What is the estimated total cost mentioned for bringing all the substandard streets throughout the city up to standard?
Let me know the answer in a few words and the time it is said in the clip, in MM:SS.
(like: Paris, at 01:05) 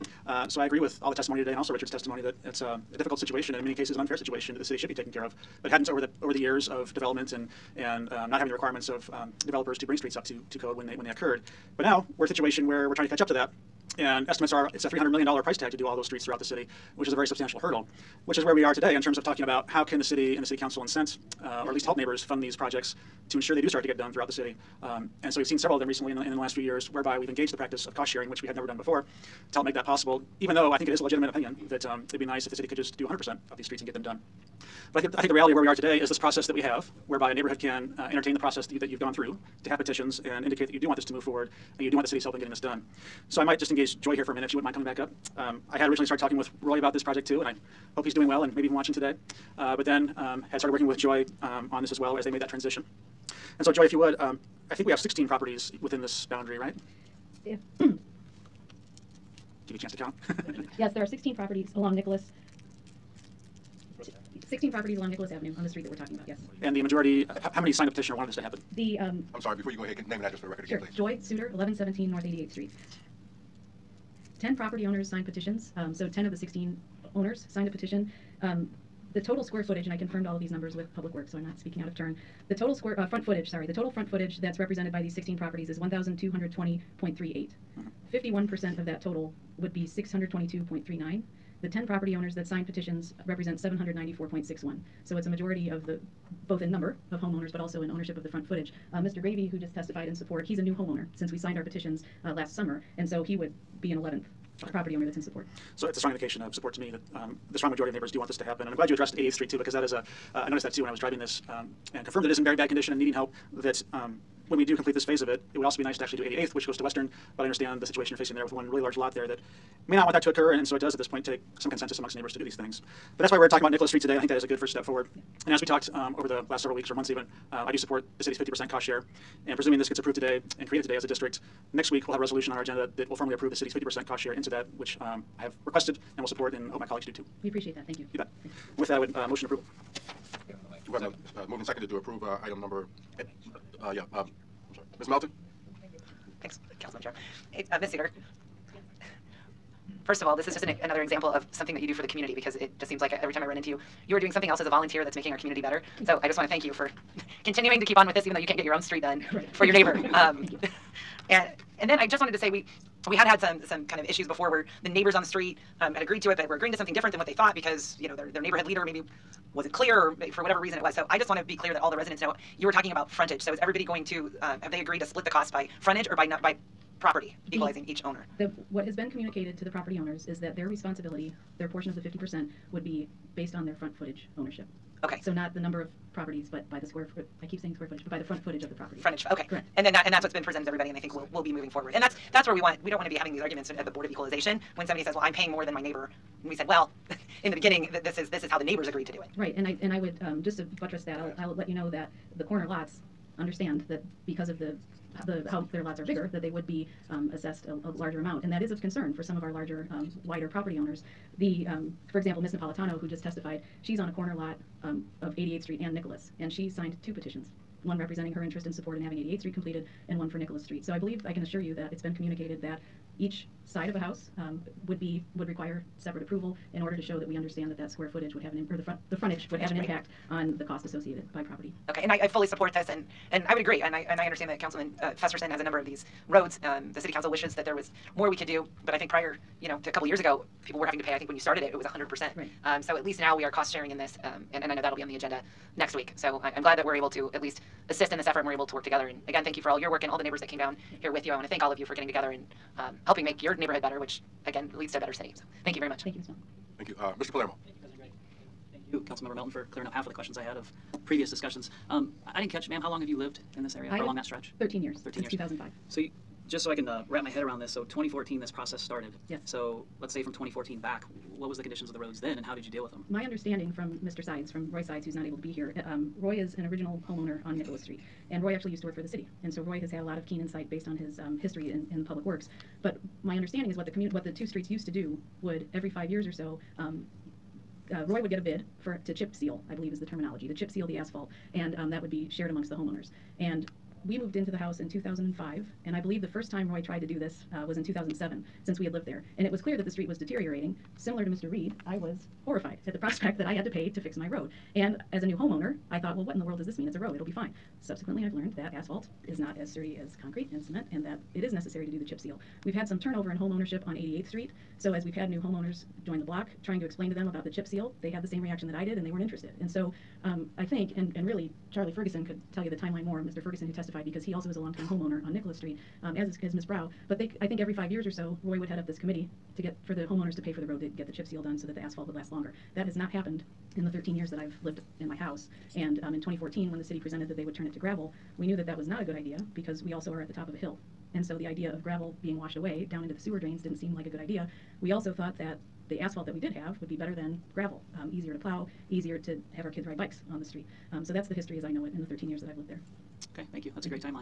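$300 million, at 00:14.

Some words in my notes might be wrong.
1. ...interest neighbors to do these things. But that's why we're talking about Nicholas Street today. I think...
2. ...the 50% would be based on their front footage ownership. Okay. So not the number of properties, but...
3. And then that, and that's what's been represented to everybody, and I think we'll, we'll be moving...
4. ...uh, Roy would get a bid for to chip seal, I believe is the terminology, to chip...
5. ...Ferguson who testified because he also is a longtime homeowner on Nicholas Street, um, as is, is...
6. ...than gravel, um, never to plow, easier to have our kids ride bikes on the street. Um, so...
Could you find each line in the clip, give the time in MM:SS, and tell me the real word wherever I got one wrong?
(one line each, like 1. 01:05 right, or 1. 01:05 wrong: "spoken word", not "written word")
1. 02:01 wrong: "amongst", not "interest"
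2. 03:01 right
3. 03:09 wrong: "presented", not "represented"
4. 04:47 right
5. 05:23 right
6. 05:47 wrong: "easier", not "never".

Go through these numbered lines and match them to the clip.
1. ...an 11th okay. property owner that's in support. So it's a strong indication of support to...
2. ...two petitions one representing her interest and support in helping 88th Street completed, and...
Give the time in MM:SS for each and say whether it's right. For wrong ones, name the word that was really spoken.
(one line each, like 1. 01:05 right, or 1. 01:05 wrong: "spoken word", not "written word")
1. 01:43 right
2. 03:37 wrong: "having", not "helping".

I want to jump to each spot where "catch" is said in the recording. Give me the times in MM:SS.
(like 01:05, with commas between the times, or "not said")
00:13, 04:22.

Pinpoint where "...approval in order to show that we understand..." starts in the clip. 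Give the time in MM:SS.
03:46.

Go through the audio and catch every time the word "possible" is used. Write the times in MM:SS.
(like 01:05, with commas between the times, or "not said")
00:29.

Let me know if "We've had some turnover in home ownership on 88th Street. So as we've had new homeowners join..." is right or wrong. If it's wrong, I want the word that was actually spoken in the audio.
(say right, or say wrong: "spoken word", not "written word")
right.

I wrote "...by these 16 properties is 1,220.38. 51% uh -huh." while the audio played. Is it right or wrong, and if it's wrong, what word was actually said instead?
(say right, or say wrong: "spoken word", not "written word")
right.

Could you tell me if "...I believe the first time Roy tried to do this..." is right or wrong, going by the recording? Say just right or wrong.
right.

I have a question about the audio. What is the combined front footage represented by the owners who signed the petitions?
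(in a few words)
794.61.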